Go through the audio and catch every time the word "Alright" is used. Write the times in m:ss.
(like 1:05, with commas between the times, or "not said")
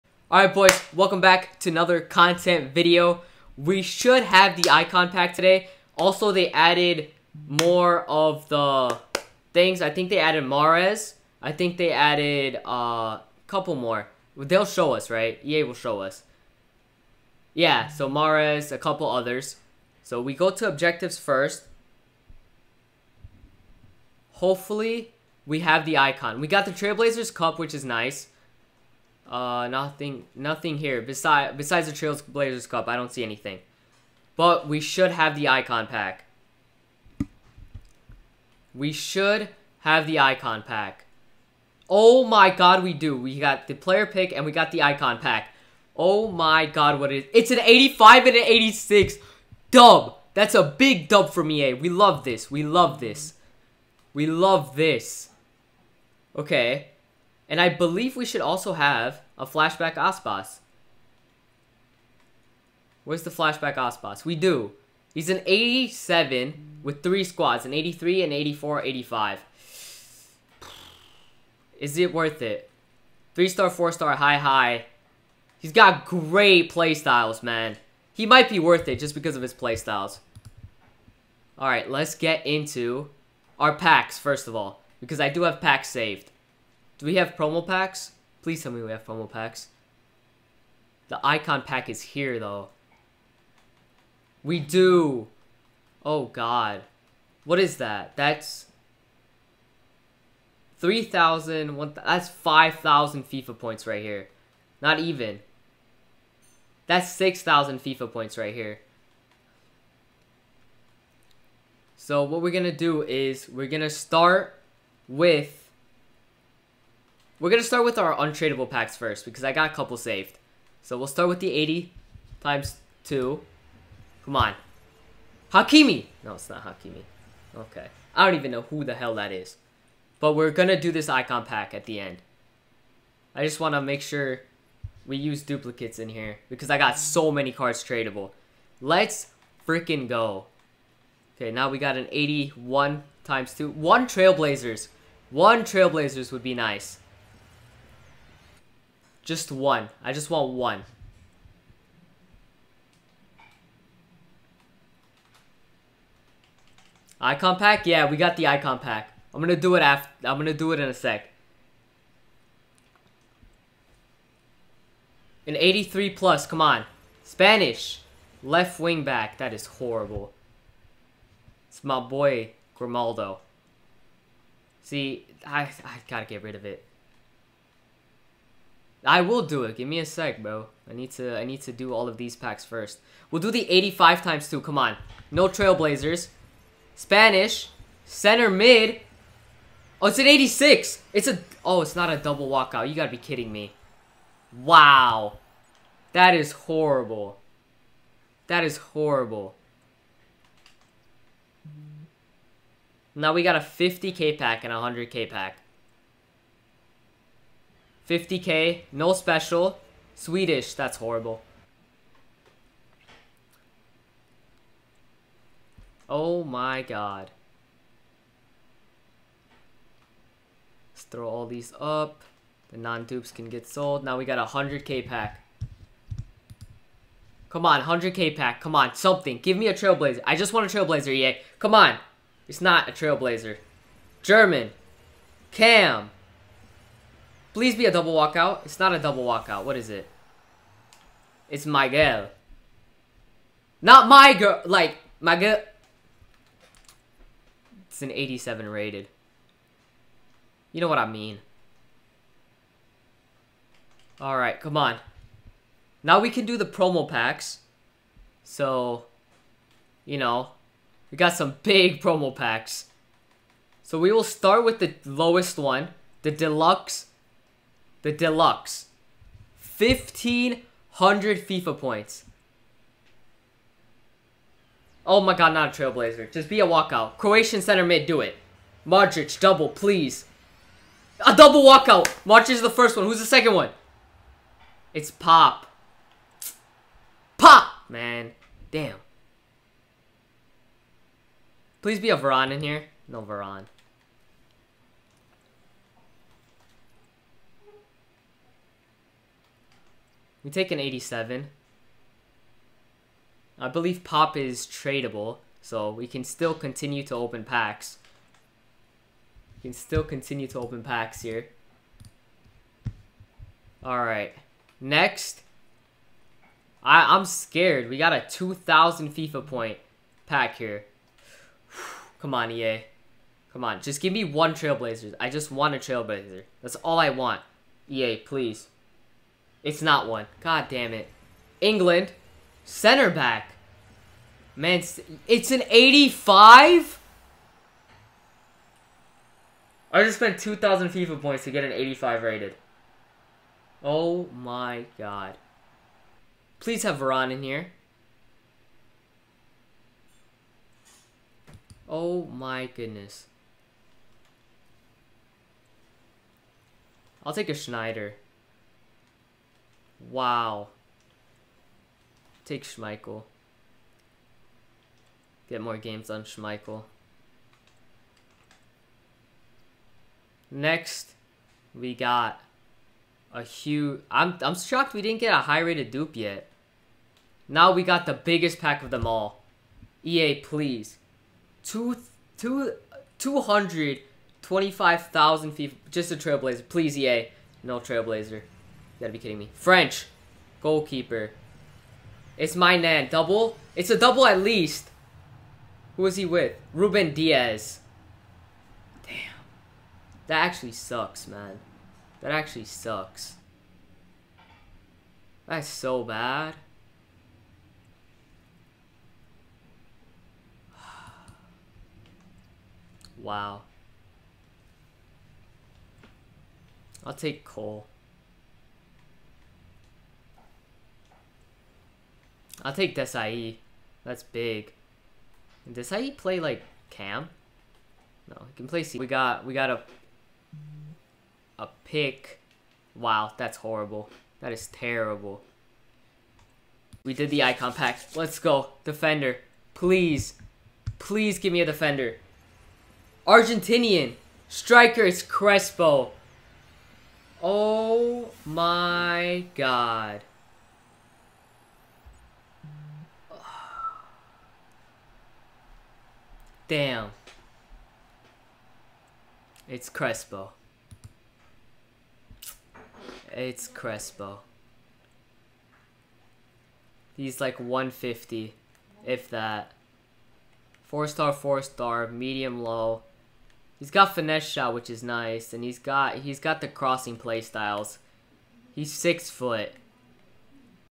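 0:00, 1:21, 4:14, 5:13.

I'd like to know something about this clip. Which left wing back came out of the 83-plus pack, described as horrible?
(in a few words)
Grimaldo.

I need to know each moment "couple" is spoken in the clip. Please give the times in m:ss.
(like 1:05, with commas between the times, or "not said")
0:13, 0:18, 1:59.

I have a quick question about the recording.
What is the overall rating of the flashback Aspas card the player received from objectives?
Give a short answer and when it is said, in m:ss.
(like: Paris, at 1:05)
87, at 1:05.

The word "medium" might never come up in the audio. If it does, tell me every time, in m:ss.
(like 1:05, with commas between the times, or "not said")
7:52.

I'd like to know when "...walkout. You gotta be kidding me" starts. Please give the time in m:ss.
3:12.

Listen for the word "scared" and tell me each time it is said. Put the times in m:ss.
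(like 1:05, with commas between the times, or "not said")
5:17.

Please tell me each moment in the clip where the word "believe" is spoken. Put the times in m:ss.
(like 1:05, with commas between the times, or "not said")
0:57, 5:03.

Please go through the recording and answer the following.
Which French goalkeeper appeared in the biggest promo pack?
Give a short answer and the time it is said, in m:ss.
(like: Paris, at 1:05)
Maignan, at 6:32.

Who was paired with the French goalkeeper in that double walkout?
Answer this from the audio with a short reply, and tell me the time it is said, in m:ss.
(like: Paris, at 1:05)
Ruben Dias, at 6:36.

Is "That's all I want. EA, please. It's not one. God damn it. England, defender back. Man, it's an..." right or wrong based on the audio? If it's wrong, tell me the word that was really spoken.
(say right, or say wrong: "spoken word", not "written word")
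wrong: "center", not "defender".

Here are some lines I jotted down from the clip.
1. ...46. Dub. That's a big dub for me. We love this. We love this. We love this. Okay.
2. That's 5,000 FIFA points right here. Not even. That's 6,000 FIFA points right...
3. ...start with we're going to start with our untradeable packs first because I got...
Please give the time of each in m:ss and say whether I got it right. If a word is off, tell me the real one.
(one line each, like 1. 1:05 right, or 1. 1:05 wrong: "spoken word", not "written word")
1. 0:48 wrong: "86", not "46"
2. 1:42 right
3. 1:53 right.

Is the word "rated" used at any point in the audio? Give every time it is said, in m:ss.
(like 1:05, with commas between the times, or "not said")
4:08, 5:42, 6:15.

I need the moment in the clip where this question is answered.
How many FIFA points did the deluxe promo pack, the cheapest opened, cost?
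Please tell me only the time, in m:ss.
4:29.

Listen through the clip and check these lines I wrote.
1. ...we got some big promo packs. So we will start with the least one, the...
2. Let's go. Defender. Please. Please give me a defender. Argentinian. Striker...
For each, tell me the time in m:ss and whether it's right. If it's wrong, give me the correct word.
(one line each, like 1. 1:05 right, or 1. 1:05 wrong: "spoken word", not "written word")
1. 4:21 wrong: "lowest", not "least"
2. 7:18 right.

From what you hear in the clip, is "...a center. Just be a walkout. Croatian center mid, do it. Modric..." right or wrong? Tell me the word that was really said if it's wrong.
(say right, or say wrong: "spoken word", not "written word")
wrong: "trailblazer", not "center".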